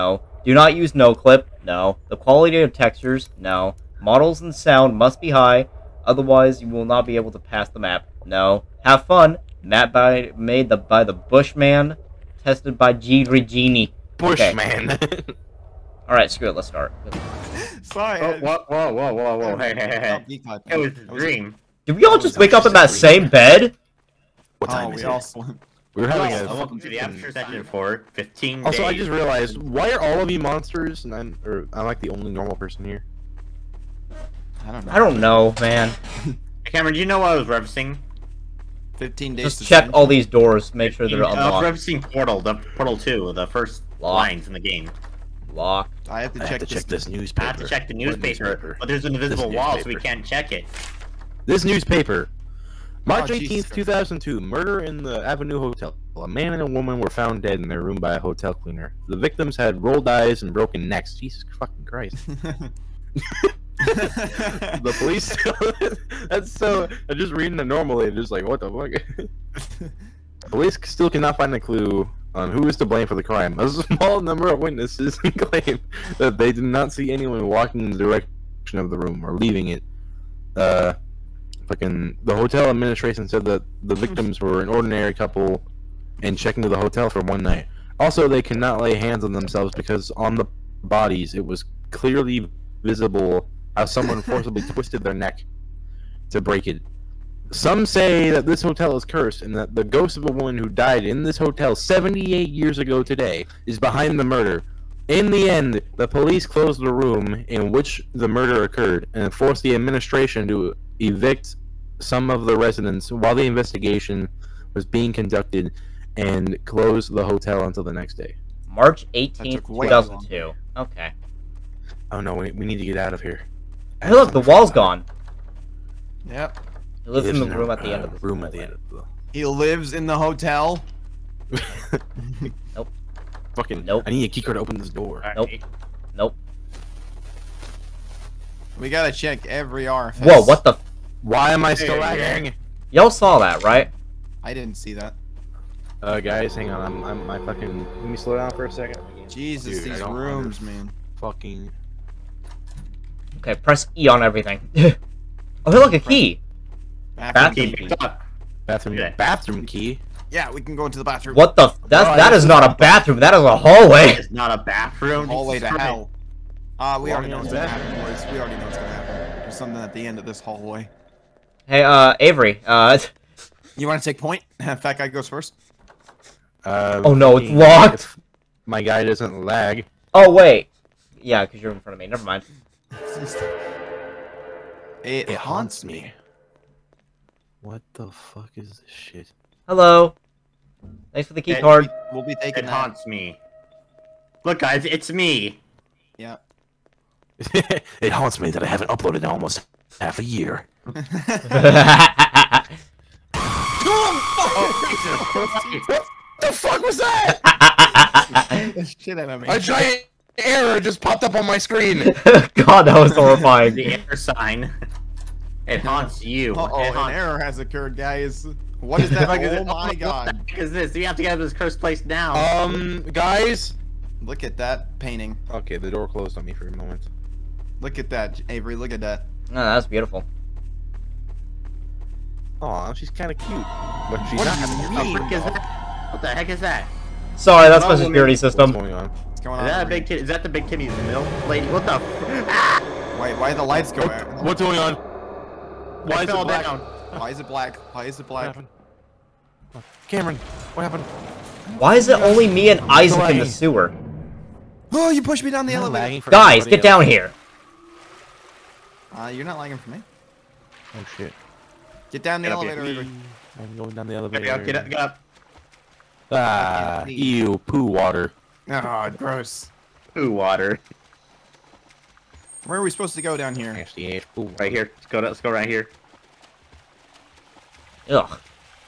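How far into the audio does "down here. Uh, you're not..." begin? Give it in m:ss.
4:16.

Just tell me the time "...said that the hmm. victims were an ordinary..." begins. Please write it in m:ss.
1:23.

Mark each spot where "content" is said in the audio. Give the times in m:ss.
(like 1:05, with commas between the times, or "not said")
not said.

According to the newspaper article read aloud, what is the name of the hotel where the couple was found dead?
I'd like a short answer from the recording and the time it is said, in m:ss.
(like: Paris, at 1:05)
Avenue Hotel, at 0:55.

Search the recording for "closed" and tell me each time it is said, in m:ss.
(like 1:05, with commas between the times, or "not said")
1:46, 1:56, 3:46.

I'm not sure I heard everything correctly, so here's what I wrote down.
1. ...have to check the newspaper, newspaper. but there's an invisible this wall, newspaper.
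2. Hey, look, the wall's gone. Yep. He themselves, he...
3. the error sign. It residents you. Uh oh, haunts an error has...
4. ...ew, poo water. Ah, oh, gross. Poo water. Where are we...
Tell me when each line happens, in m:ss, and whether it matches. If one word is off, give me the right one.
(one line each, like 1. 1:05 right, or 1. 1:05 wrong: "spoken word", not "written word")
1. 0:47 right
2. 2:04 wrong: "lives", not "themselves"
3. 3:33 wrong: "haunts", not "residents"
4. 4:27 right.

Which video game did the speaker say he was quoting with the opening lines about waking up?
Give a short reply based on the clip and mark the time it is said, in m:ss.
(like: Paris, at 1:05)
Portal 2, at 0:42.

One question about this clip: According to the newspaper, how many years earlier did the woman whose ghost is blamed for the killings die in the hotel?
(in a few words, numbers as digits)
78.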